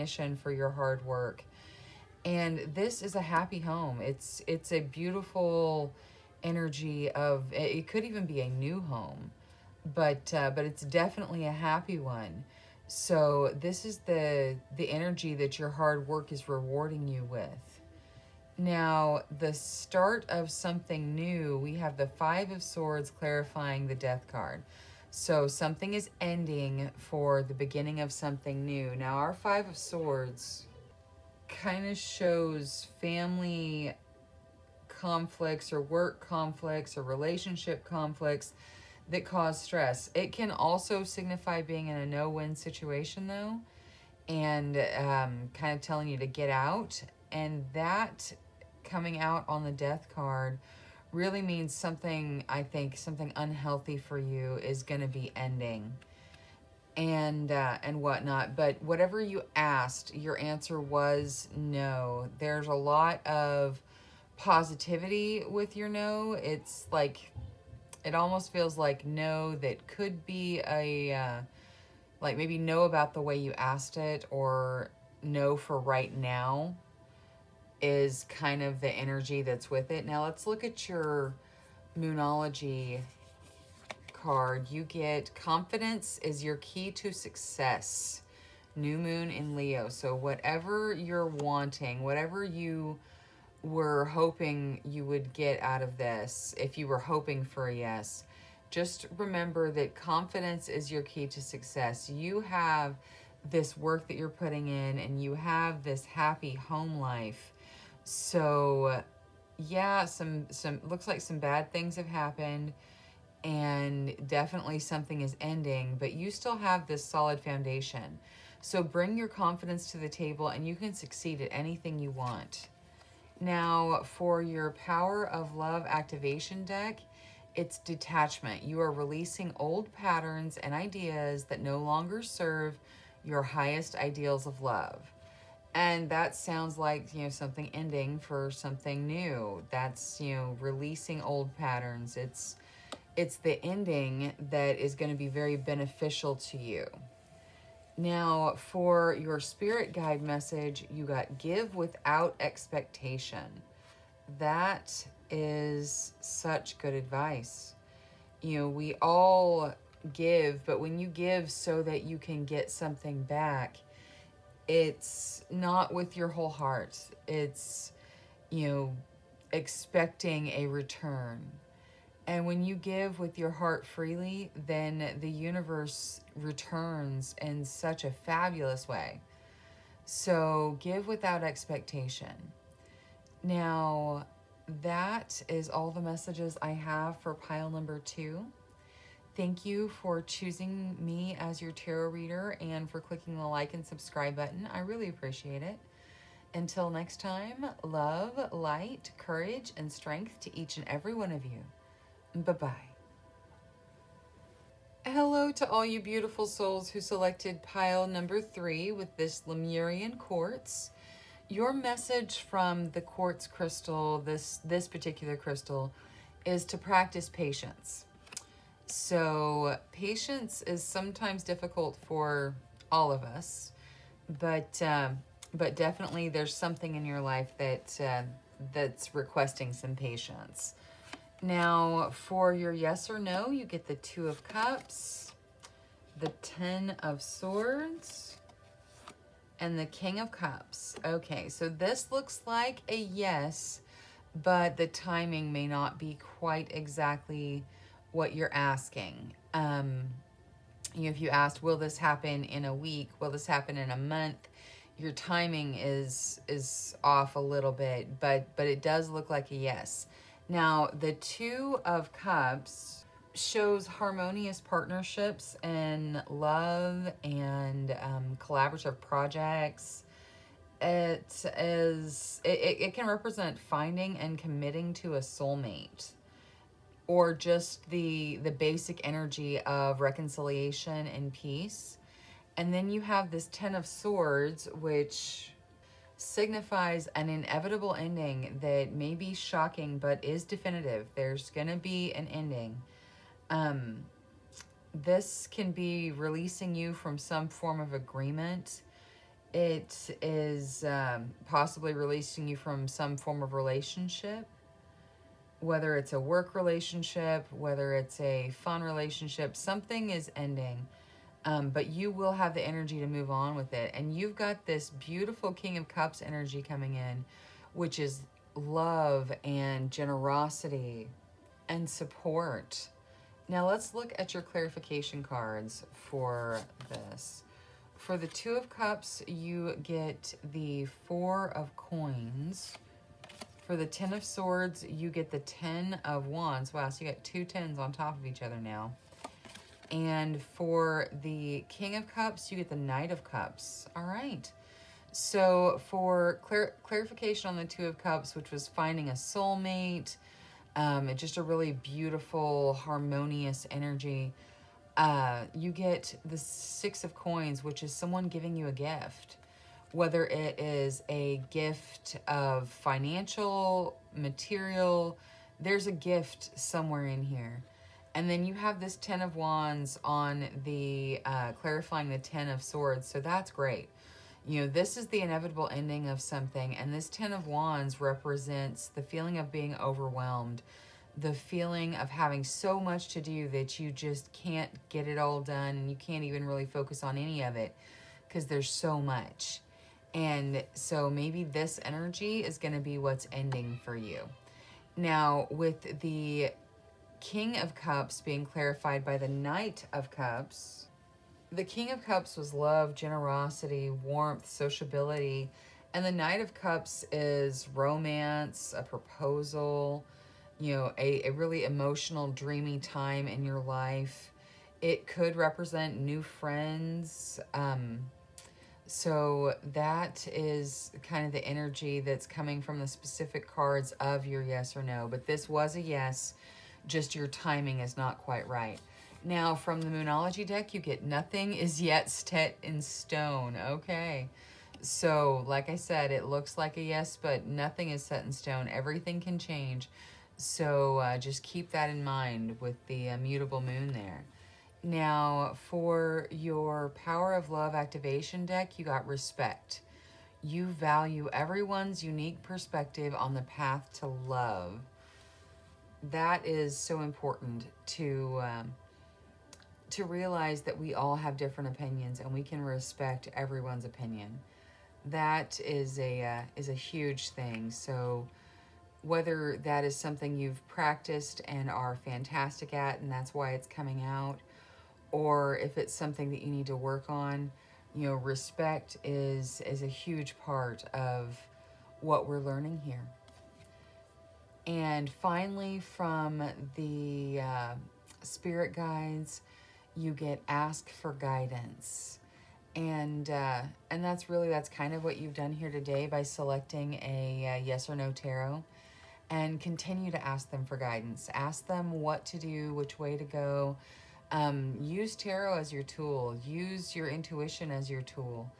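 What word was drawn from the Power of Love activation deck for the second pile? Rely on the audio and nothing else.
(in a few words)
Detachment.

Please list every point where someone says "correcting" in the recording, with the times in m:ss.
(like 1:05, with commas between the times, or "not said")
not said.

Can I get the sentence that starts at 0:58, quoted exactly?
But whatever you asked, your answer was no.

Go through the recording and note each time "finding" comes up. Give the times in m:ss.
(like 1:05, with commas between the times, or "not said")
4:33, 5:48.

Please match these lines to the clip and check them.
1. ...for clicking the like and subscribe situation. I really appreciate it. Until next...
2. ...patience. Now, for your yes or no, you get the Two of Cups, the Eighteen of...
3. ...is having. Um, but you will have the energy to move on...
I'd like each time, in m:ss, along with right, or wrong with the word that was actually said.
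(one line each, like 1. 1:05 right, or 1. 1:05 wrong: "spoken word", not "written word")
1. 3:12 wrong: "button", not "situation"
2. 3:49 wrong: "Ten", not "Eighteen"
3. 5:10 wrong: "ending", not "having".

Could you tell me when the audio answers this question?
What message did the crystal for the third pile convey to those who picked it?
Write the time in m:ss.
3:36.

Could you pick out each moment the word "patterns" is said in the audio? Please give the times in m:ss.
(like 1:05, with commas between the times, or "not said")
2:09, 2:21.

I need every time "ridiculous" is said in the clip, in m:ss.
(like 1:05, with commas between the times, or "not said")
not said.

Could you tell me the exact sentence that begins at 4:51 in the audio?
There's going to be an ending.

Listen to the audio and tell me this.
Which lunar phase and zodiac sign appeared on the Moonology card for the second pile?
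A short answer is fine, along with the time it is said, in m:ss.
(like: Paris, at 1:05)
New moon in Leo, at 1:28.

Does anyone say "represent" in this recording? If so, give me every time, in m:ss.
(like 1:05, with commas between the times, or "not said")
4:33, 6:18, 6:55.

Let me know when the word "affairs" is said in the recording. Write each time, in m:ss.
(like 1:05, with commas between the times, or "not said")
not said.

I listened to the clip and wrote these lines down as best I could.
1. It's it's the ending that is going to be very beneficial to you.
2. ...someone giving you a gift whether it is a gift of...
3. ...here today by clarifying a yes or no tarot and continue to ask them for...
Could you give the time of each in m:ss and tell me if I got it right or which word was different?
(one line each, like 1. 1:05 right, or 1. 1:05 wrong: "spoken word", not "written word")
1. 2:22 right
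2. 5:57 right
3. 8:15 wrong: "selecting", not "clarifying".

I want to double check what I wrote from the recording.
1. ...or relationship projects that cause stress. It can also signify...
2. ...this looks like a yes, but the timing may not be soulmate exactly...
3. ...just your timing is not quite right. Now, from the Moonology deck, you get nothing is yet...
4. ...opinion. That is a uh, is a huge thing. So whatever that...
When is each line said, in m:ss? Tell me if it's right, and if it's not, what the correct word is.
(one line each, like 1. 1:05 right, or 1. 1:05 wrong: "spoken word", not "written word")
1. 0:36 wrong: "conflicts", not "projects"
2. 4:01 wrong: "quite", not "soulmate"
3. 7:06 right
4. 7:43 wrong: "whether", not "whatever".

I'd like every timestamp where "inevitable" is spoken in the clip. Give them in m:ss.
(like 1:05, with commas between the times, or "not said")
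4:47, 6:15.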